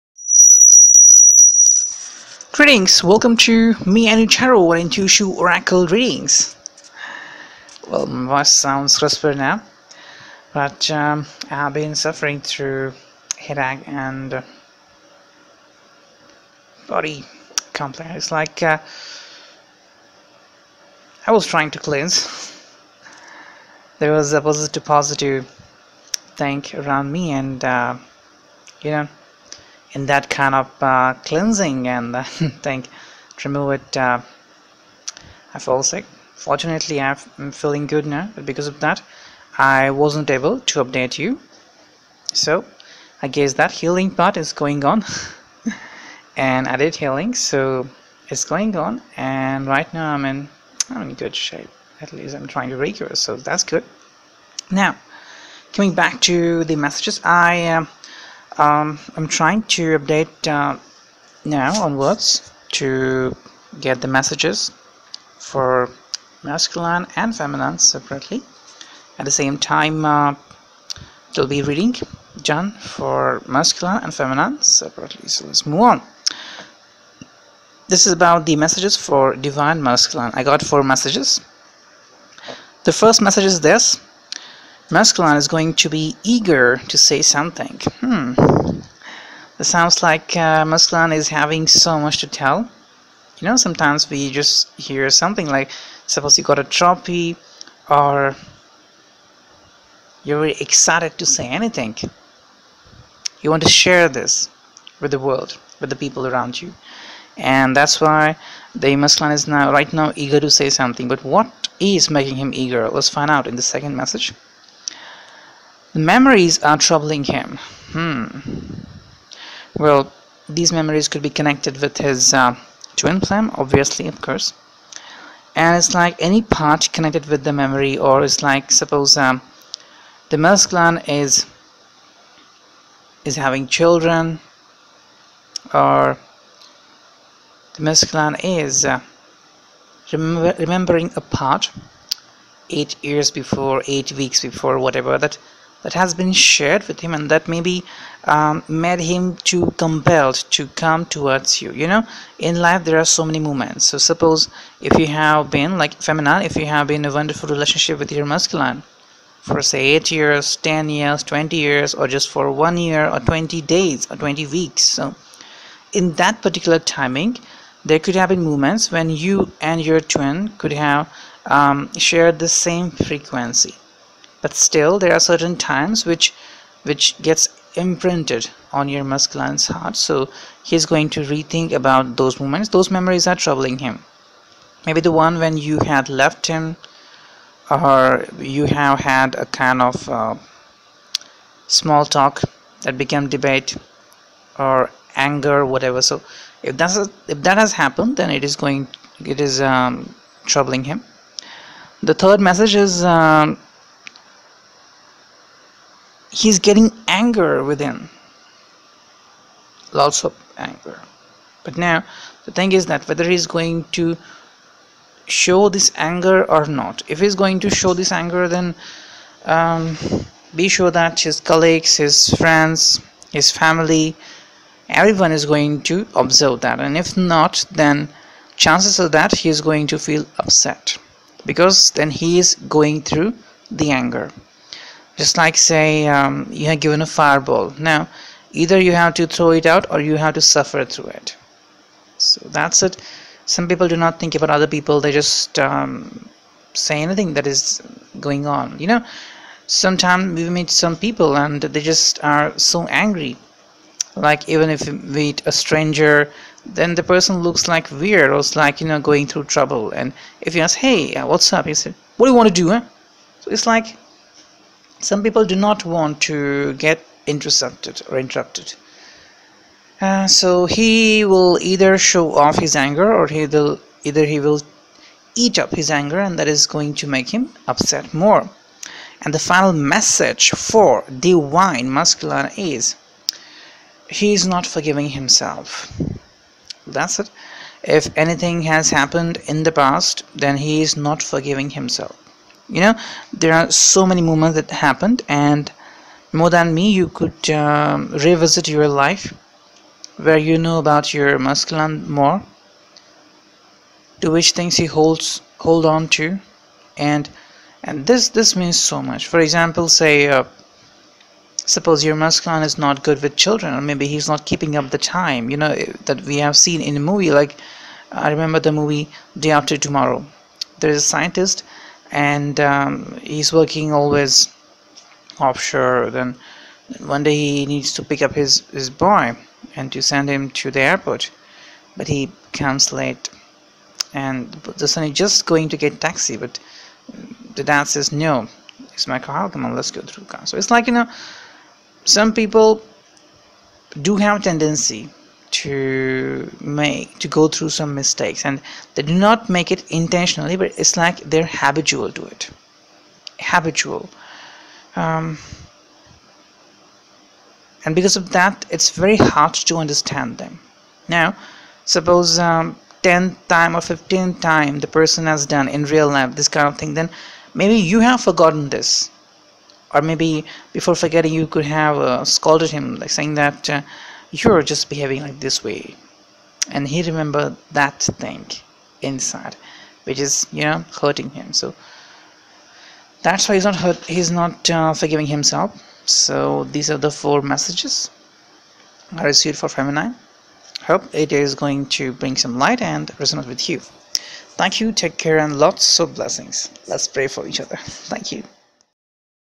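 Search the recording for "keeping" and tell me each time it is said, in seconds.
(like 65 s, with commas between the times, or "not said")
314 s.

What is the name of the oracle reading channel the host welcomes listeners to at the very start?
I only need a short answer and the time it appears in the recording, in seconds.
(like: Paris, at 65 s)
Anu Charo and Tushu Oracle Readings, at 4 s.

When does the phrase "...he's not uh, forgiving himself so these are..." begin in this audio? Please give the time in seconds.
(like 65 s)
384 s.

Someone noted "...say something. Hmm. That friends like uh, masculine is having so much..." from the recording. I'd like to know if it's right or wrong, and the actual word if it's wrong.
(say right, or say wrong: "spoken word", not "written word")
wrong: "sounds", not "friends".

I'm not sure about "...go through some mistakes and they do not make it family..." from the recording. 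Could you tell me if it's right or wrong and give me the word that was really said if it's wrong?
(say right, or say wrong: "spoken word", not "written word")
wrong: "intentionally", not "family".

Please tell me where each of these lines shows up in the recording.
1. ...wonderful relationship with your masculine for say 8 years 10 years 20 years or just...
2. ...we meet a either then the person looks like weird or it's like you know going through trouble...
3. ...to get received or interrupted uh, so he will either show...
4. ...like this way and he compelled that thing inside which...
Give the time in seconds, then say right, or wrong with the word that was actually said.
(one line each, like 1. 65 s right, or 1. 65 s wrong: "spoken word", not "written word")
1. 157 s right
2. 254 s wrong: "stranger", not "either"
3. 266 s wrong: "intercepted", not "received"
4. 375 s wrong: "remembered", not "compelled".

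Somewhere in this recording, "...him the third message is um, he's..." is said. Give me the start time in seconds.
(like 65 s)
200 s.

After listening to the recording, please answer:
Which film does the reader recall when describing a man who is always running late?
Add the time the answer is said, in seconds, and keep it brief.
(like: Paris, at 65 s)
Day After Tomorrow, at 319 s.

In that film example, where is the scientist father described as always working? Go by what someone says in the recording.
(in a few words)
Offshore.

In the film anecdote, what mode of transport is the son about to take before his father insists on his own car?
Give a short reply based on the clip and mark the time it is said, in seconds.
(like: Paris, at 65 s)
Taxi, at 336 s.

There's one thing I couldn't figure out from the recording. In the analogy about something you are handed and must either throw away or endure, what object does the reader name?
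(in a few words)
Fireball.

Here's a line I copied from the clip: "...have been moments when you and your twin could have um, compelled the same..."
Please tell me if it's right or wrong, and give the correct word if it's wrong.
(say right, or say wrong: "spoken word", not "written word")
wrong: "shared", not "compelled".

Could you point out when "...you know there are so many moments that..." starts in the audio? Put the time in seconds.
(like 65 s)
292 s.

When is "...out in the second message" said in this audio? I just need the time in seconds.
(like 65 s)
113 s.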